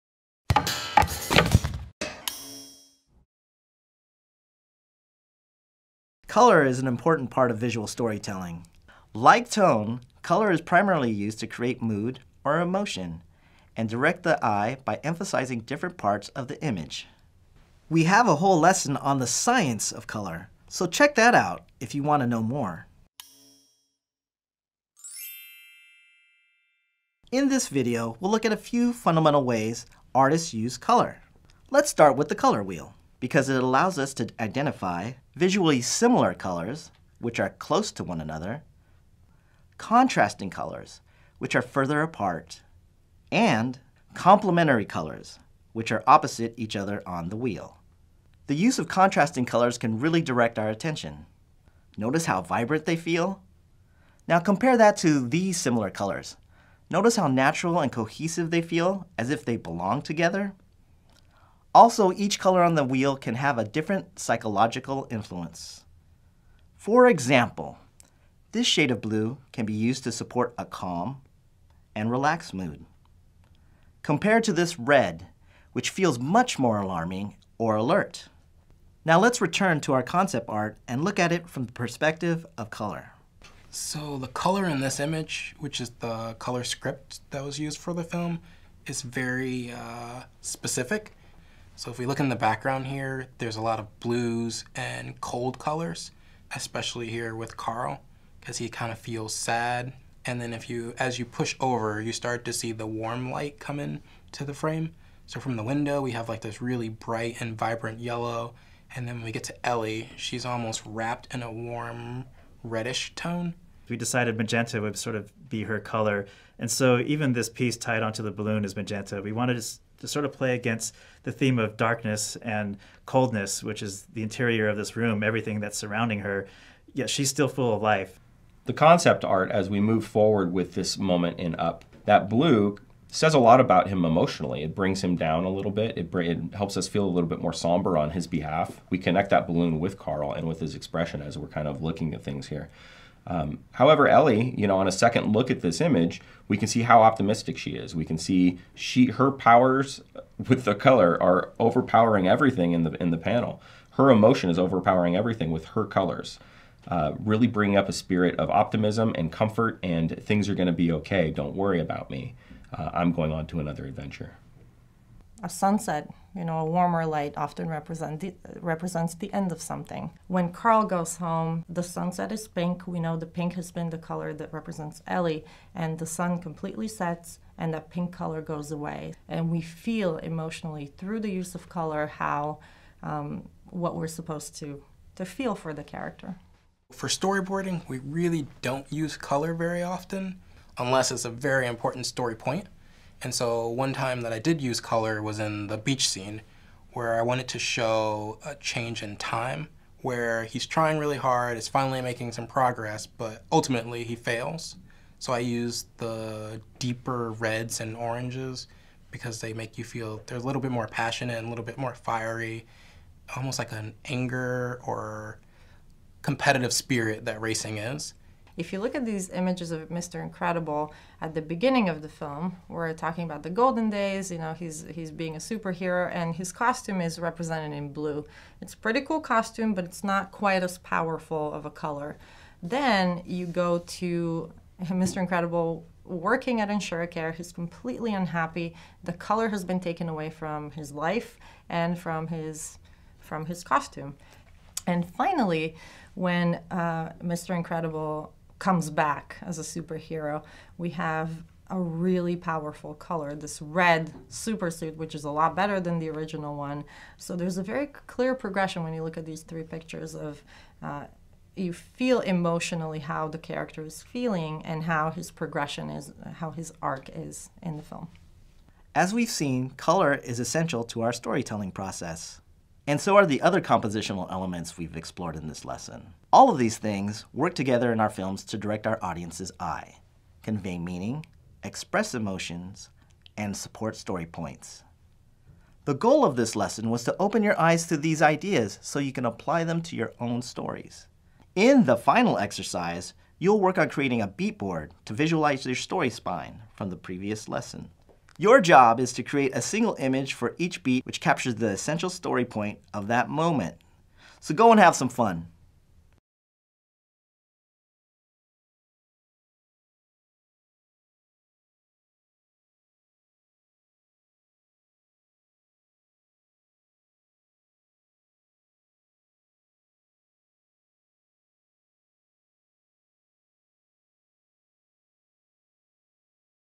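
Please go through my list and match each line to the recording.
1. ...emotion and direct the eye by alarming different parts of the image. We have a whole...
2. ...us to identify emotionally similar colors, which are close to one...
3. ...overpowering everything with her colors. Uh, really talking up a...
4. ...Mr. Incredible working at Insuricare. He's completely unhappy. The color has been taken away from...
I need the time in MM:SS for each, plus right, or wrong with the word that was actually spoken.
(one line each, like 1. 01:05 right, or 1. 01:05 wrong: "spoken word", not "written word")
1. 00:12 wrong: "emphasizing", not "alarming"
2. 00:33 wrong: "visually", not "emotionally"
3. 02:34 wrong: "bringing", not "talking"
4. 03:55 right.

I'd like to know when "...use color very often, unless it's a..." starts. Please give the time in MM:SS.
03:08.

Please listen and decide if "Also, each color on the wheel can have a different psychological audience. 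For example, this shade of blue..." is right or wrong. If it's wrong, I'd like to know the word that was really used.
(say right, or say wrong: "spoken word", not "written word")
wrong: "influence", not "audience".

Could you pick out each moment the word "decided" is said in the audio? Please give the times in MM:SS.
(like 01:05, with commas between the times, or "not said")
01:53.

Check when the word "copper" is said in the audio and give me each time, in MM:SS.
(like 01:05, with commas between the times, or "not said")
not said.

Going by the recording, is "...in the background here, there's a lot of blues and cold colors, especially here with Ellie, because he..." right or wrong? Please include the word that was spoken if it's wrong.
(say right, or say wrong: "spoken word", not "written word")
wrong: "Carl", not "Ellie".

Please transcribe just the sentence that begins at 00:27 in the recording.
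In this video, we'll look at a few fundamental ways artists use color.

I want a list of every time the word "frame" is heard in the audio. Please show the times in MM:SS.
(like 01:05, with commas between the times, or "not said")
01:44.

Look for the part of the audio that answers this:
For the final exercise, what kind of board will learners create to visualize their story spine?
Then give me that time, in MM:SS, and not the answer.
04:54.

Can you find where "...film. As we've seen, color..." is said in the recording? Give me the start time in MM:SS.
04:27.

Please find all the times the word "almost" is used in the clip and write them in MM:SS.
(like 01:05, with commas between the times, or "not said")
01:50, 03:33.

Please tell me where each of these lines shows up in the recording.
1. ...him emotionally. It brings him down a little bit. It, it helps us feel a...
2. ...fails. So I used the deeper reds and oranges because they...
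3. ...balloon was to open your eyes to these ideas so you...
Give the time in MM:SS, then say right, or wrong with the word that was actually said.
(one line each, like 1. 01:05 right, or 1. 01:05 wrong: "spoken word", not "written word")
1. 02:13 right
2. 03:24 right
3. 04:46 wrong: "lesson", not "balloon".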